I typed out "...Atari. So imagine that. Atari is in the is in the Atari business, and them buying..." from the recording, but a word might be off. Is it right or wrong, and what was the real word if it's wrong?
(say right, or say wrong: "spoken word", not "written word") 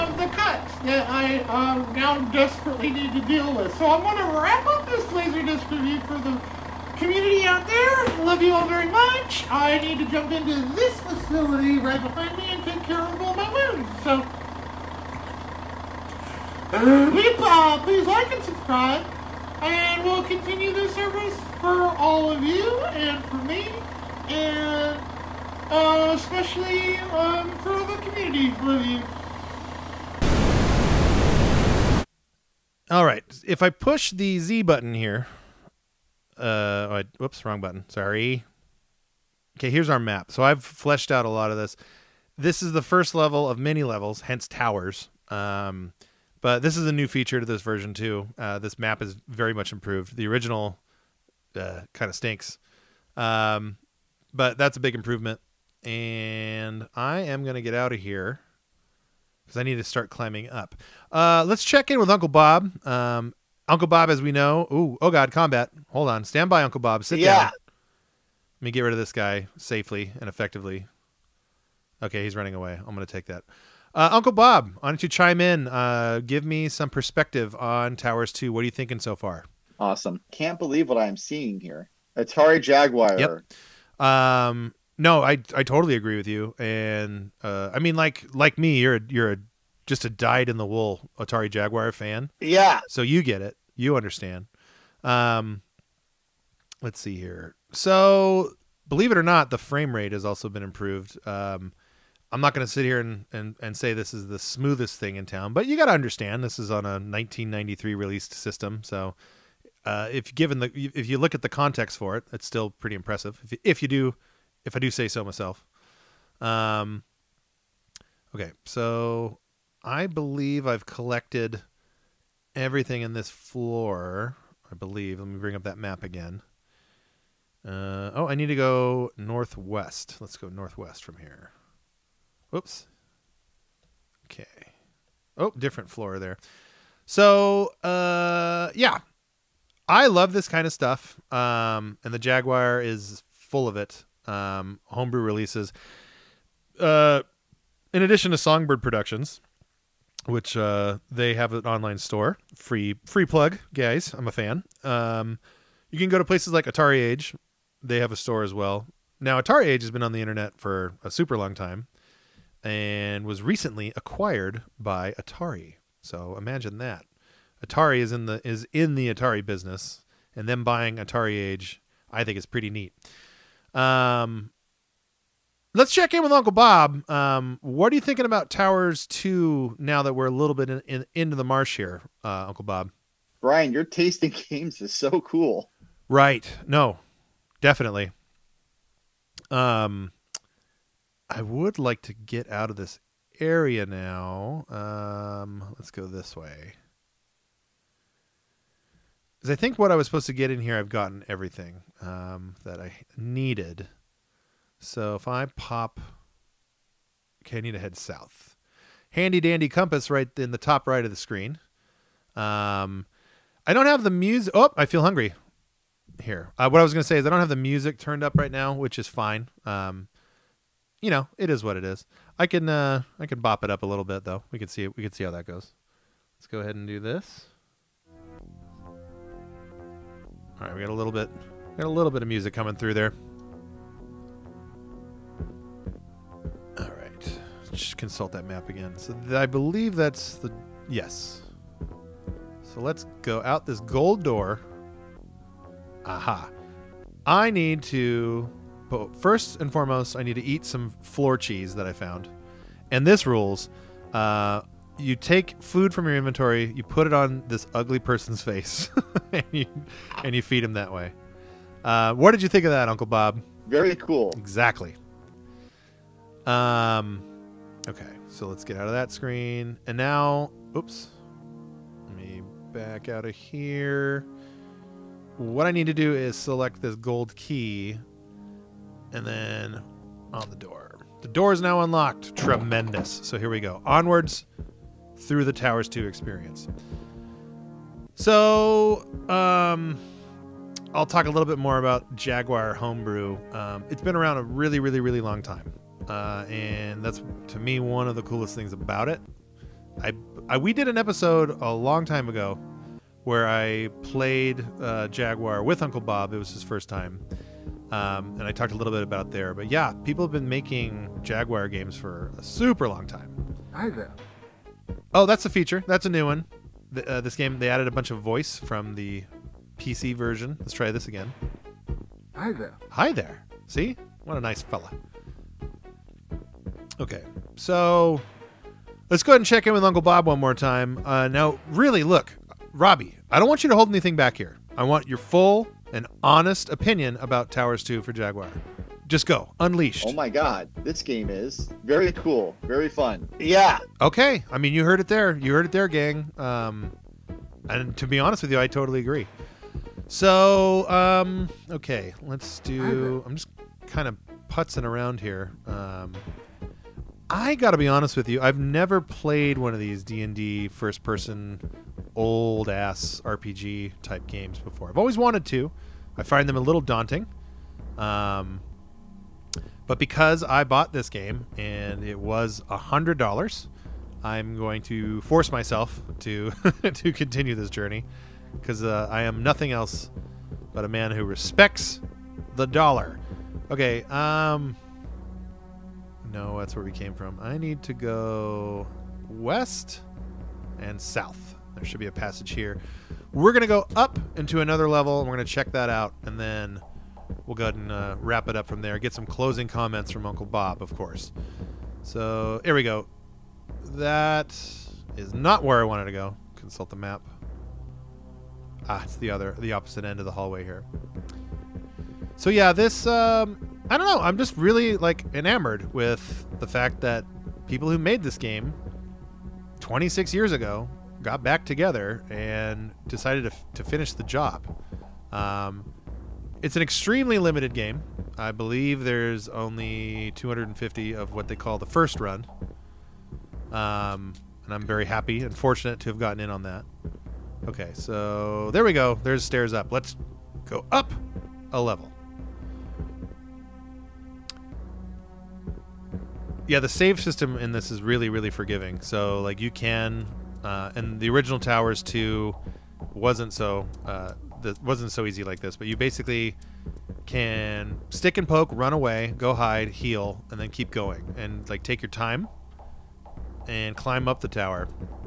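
right.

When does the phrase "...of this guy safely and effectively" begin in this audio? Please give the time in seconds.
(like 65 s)
68 s.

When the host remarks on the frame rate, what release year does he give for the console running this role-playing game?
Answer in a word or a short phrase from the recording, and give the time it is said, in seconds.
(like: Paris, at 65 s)
1993, at 106 s.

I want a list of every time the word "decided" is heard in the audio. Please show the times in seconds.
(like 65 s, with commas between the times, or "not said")
423 s.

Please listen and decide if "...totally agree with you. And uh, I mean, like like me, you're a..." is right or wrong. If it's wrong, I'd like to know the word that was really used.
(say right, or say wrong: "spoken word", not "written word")
right.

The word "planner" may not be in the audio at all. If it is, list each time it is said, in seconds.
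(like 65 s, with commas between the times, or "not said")
not said.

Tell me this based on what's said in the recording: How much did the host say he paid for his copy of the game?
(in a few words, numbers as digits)
$100.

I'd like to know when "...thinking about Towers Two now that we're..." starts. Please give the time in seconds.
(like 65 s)
178 s.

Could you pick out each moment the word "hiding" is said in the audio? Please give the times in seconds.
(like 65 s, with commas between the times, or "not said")
not said.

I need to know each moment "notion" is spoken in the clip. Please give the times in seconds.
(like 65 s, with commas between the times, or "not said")
not said.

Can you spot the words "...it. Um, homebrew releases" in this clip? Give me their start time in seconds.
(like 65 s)
143 s.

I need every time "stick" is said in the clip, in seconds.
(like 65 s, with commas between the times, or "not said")
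458 s.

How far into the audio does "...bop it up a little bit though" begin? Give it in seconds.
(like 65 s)
223 s.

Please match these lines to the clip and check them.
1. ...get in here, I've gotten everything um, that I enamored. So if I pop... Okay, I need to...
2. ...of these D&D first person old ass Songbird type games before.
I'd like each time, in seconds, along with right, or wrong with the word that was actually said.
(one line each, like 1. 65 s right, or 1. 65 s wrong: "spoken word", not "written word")
1. 200 s wrong: "needed", not "enamored"
2. 359 s wrong: "RPG", not "Songbird".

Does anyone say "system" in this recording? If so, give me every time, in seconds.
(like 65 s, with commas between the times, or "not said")
108 s, 447 s.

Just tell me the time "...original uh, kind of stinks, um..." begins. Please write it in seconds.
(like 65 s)
50 s.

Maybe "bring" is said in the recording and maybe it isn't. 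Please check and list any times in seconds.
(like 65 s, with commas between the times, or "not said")
125 s.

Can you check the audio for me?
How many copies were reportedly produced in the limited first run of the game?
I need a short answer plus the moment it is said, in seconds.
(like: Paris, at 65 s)
250, at 430 s.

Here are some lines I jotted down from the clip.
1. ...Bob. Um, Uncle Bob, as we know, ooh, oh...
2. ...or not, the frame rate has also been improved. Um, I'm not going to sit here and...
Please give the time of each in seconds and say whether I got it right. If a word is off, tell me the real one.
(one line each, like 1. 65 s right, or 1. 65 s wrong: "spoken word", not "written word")
1. 62 s right
2. 99 s right.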